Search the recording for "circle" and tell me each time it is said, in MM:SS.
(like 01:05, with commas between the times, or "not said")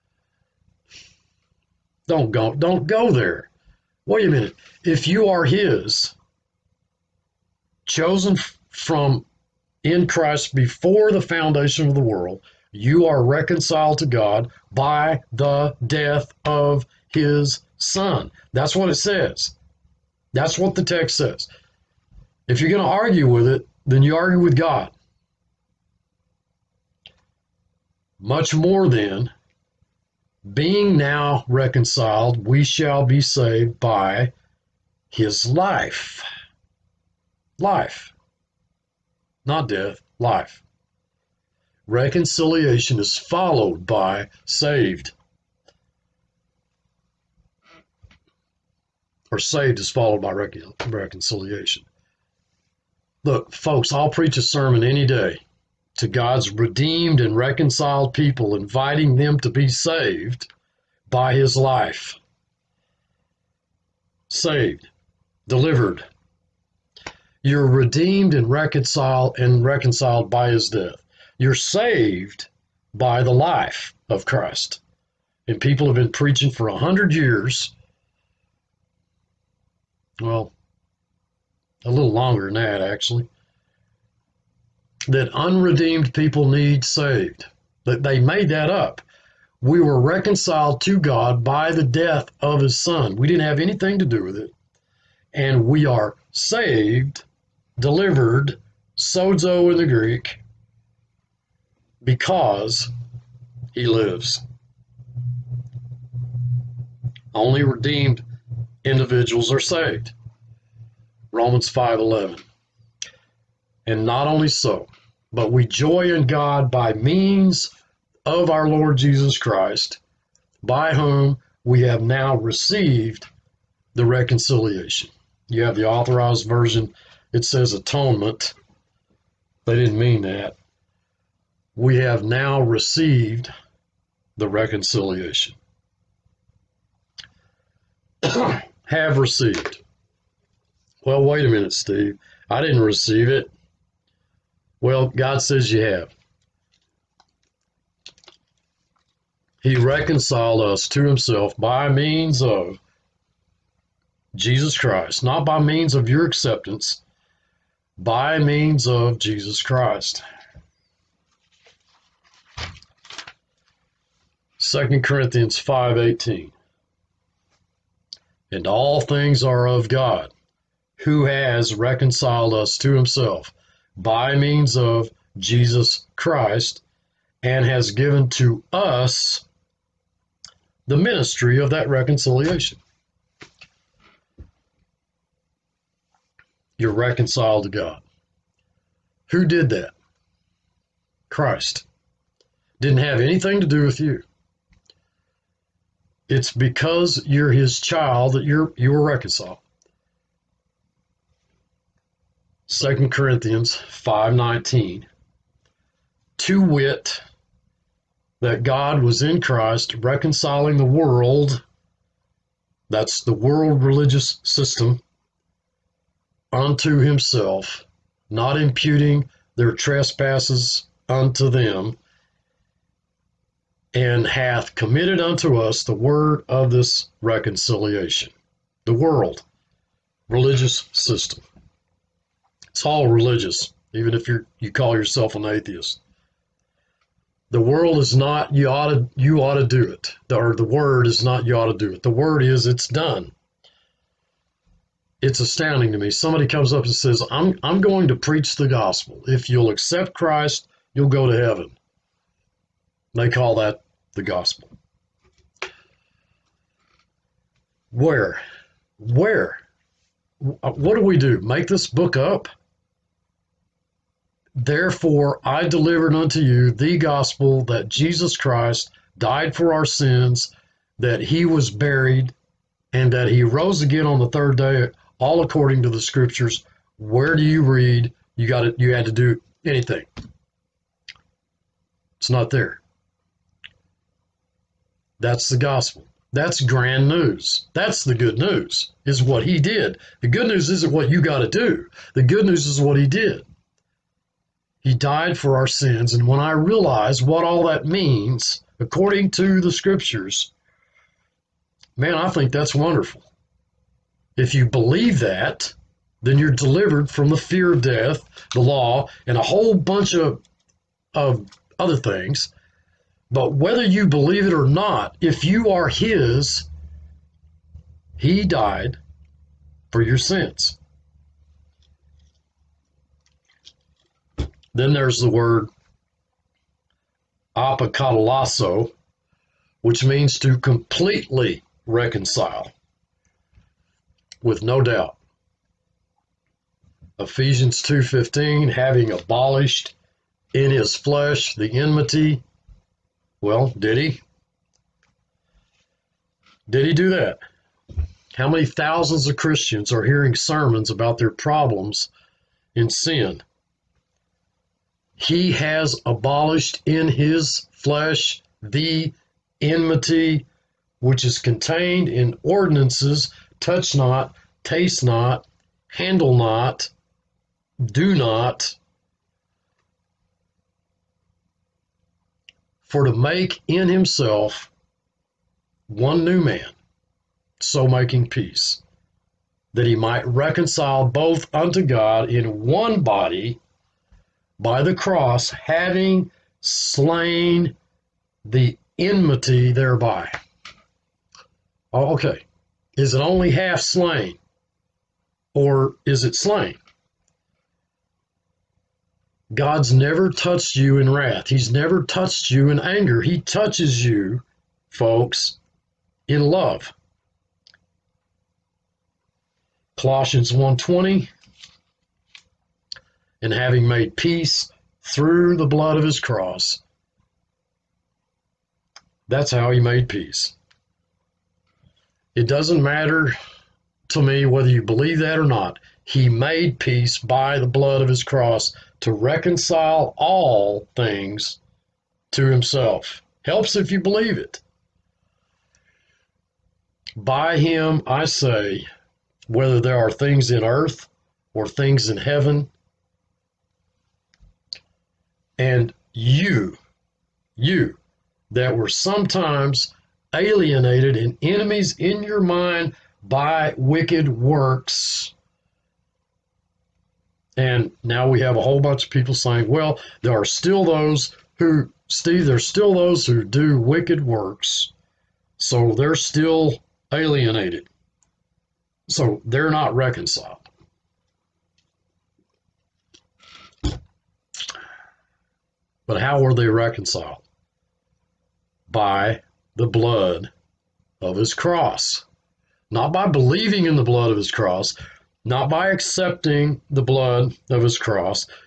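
not said.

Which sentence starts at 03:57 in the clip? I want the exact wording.
The world is not you ought to you ought to do it.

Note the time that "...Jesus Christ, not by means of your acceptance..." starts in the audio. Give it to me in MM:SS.
02:34.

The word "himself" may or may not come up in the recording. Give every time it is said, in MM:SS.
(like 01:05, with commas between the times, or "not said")
02:31, 02:52, 03:36, 06:13, 07:12.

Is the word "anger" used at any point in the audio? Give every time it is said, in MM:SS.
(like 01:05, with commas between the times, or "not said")
06:42.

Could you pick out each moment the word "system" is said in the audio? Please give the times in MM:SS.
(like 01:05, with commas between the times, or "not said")
03:34, 03:50.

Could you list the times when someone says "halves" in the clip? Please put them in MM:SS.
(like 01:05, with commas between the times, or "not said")
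not said.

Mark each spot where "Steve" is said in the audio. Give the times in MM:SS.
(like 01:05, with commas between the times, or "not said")
02:21, 07:42.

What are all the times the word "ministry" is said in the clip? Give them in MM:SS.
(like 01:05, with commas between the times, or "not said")
03:00.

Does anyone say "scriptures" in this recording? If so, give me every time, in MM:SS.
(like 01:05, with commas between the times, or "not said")
04:36, 04:59.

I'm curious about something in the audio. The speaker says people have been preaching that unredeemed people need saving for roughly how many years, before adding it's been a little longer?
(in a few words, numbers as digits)
100.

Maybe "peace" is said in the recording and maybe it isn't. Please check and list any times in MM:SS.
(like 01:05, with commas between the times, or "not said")
06:18, 06:54, 07:00, 07:06.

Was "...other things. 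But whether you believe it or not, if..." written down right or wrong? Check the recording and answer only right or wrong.
right.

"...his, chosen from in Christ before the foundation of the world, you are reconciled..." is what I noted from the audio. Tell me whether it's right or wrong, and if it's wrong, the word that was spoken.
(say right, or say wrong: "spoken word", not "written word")
right.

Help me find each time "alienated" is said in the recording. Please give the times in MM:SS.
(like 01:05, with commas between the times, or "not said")
07:30, 07:47.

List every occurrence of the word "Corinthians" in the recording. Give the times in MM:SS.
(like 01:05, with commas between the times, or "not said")
02:45, 03:23.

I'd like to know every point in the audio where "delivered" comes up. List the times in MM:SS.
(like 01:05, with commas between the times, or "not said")
01:05, 01:37, 04:25, 05:06.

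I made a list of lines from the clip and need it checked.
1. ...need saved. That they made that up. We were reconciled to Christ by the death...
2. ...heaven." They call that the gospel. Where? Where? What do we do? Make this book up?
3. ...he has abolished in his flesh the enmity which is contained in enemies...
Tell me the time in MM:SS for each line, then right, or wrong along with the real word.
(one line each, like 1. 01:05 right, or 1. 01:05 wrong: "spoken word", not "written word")
1. 01:26 wrong: "God", not "Christ"
2. 04:11 right
3. 05:55 wrong: "ordinances", not "enemies".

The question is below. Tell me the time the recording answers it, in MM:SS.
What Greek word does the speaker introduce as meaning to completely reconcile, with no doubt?
05:27.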